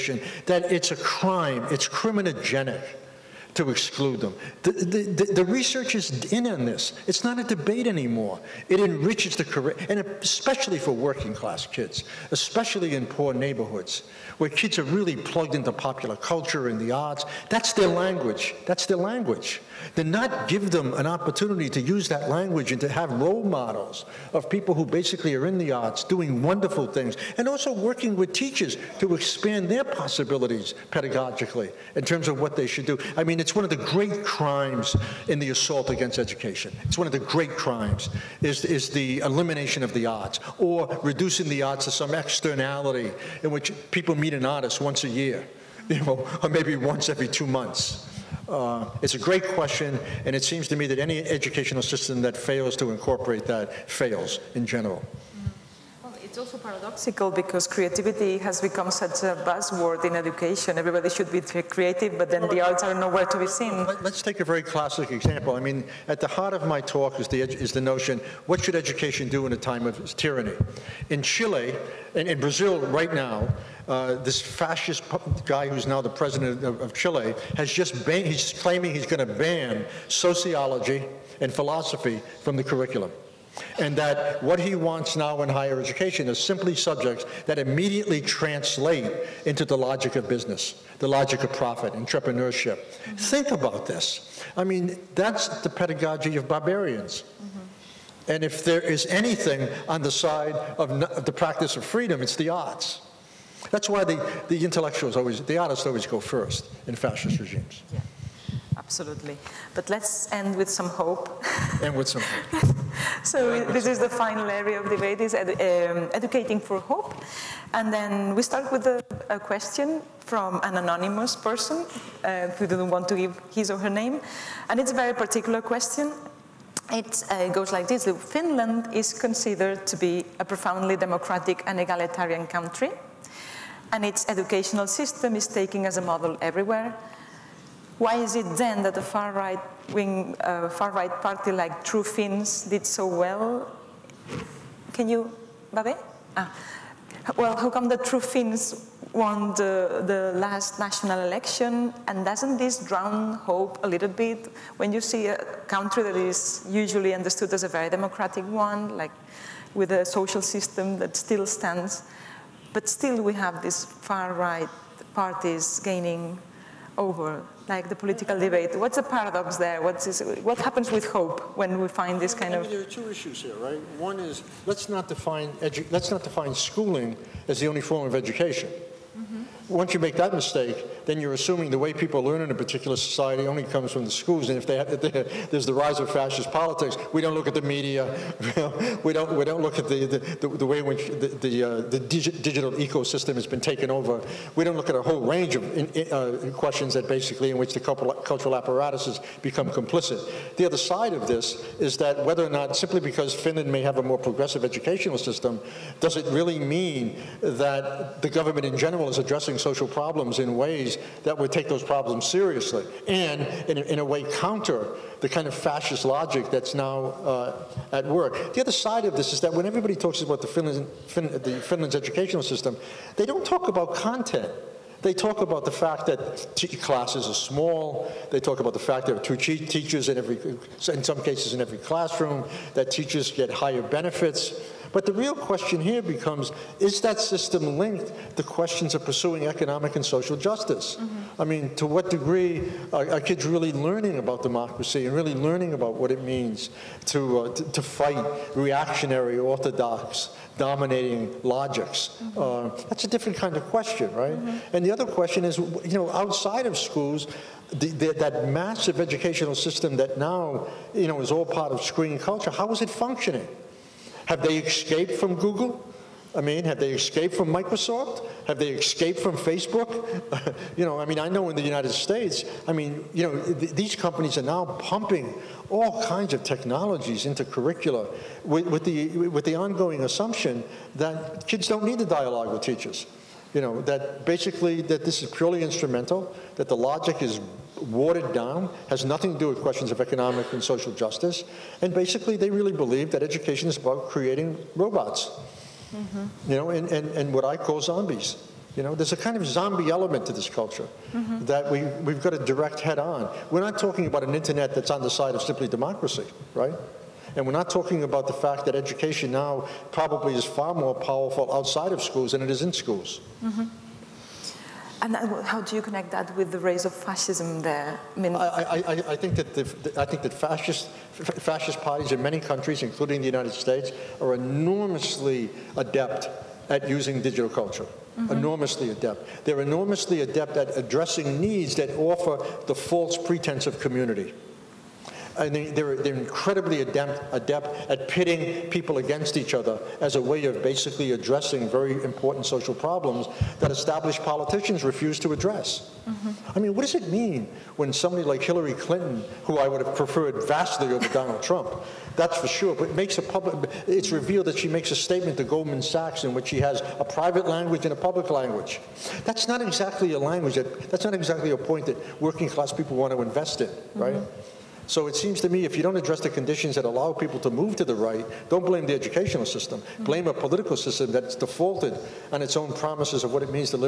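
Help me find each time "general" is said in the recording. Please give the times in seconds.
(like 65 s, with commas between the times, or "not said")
54 s, 208 s.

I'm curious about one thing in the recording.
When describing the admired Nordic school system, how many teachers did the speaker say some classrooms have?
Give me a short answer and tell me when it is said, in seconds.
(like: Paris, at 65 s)
2, at 229 s.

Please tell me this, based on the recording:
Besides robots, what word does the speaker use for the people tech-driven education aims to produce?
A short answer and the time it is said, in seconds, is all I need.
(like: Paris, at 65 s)
zombies, at 297 s.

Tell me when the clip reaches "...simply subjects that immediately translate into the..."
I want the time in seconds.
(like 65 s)
86 s.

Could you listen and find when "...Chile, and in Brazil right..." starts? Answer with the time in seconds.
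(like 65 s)
71 s.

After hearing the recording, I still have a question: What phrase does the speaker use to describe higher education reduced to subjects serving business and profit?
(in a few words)
pedagogy of barbarians.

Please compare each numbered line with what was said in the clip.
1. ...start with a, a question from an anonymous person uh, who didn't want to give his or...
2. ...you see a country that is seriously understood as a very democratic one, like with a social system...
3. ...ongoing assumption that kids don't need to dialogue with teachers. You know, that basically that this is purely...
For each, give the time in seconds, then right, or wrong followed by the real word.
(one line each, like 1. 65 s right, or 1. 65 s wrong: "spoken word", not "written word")
1. 118 s right
2. 154 s wrong: "usually", not "seriously"
3. 279 s right.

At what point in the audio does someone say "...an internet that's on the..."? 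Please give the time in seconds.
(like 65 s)
304 s.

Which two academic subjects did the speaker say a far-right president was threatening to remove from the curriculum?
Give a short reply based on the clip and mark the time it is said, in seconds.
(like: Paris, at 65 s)
sociology and philosophy, at 80 s.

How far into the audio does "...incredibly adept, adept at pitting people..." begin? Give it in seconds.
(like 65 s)
336 s.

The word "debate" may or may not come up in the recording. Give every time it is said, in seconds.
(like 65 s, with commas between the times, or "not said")
7 s, 114 s, 168 s.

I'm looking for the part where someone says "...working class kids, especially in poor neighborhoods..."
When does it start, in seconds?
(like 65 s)
10 s.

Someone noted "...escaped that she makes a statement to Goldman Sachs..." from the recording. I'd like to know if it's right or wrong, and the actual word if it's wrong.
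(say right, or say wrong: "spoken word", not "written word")
wrong: "revealed", not "escaped".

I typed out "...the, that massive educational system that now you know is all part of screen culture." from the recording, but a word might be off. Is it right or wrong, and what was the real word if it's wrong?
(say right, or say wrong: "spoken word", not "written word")
right.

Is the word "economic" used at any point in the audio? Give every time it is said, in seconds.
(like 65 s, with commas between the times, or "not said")
239 s, 289 s.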